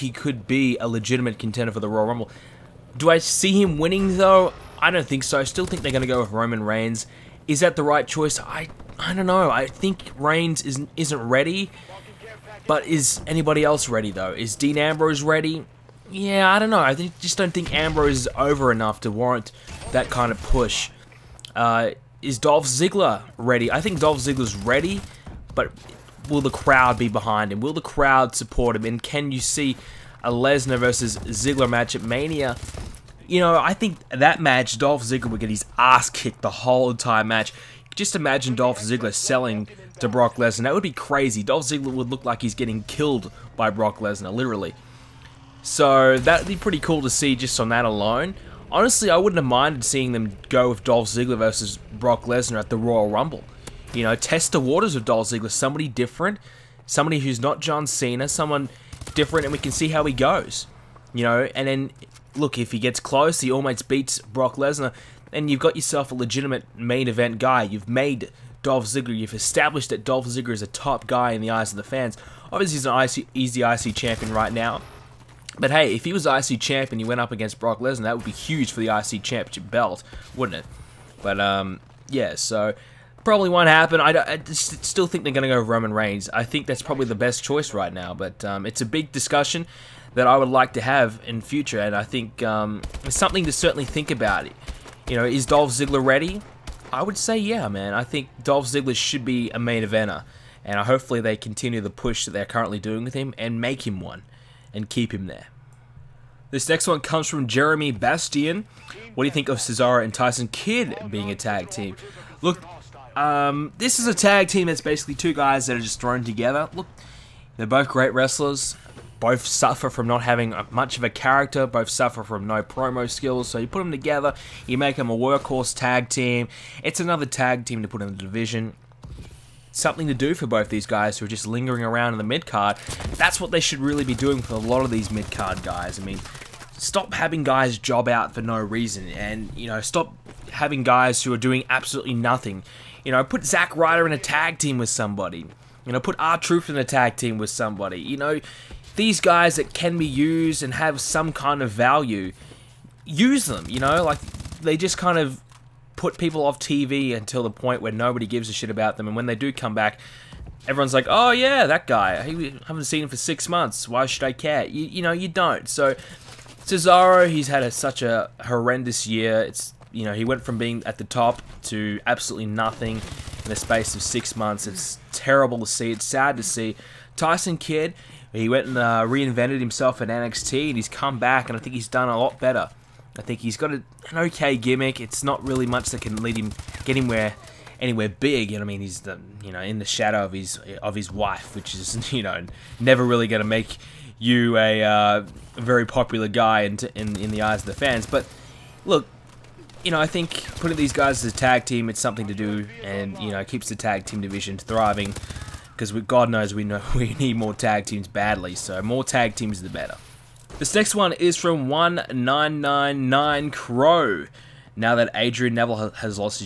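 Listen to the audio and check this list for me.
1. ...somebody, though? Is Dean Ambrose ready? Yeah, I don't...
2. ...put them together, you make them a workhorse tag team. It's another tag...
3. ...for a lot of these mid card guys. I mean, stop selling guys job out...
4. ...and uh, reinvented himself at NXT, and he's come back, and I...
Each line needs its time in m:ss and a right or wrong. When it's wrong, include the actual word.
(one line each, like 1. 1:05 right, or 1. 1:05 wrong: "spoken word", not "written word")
1. 0:13 wrong: "ready", not "somebody"
2. 2:03 right
3. 2:14 wrong: "having", not "selling"
4. 2:58 right.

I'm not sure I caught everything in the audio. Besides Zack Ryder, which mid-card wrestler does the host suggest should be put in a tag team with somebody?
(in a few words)
R-Truth.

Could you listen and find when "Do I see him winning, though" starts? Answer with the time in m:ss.
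0:02.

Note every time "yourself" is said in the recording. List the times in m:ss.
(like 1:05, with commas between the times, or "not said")
1:05.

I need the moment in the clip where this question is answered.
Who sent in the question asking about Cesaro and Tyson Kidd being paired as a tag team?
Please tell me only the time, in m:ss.
1:47.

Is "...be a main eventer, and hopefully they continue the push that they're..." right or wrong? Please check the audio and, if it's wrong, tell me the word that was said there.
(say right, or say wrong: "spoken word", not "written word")
right.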